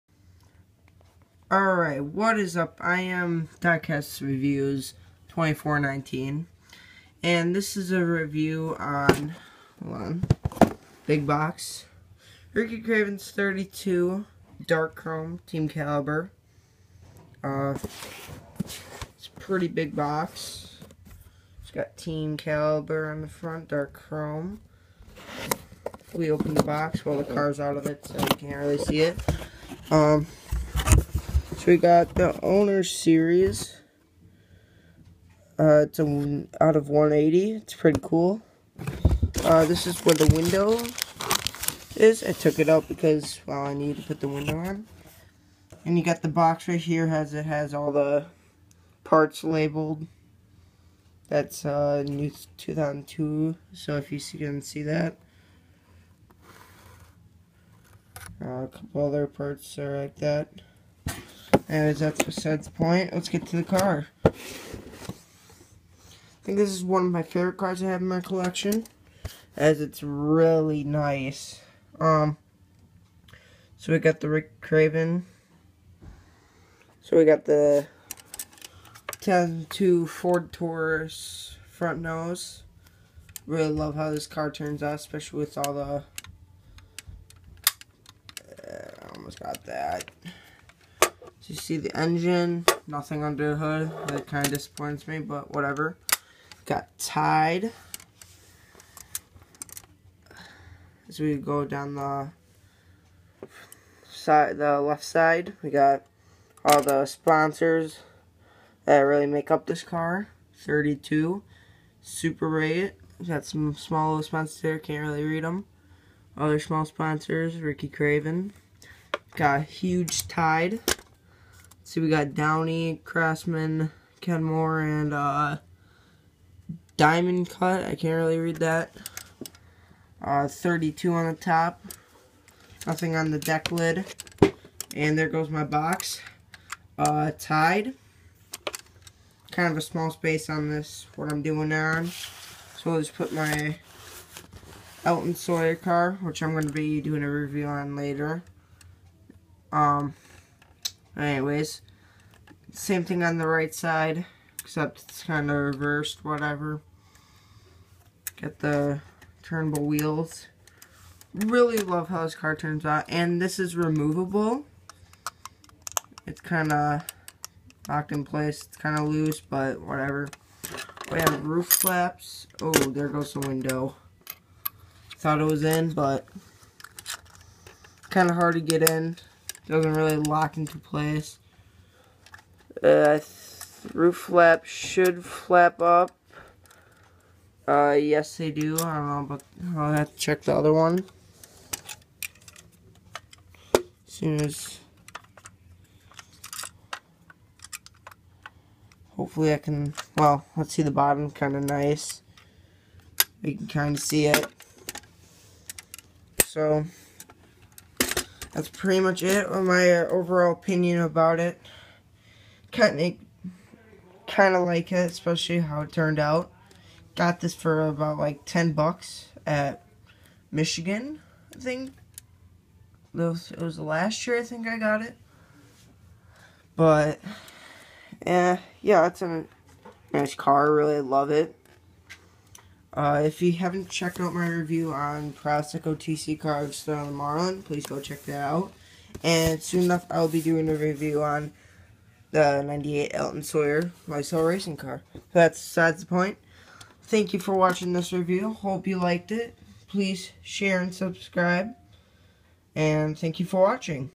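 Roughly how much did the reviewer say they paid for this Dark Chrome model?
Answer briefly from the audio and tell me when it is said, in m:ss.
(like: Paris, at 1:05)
$10, at 3:38.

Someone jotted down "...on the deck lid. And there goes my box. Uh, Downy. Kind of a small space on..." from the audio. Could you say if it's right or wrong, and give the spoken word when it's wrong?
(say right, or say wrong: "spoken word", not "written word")
wrong: "Tide", not "Downy".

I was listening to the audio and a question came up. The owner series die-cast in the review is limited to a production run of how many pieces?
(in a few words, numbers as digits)
180.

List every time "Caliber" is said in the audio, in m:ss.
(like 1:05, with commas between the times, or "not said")
0:15, 0:22.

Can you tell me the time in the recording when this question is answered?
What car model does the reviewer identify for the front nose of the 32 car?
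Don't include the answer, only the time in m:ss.
1:19.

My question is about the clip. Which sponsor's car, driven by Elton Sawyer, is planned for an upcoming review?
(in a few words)
Lysol.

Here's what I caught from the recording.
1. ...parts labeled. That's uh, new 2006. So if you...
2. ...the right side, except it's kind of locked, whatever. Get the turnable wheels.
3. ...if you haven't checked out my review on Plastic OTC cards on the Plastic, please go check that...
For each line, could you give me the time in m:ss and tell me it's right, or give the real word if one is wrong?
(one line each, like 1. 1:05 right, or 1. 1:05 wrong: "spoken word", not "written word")
1. 0:49 wrong: "2002", not "2006"
2. 2:33 wrong: "reversed", not "locked"
3. 3:53 wrong: "Marlin", not "Plastic".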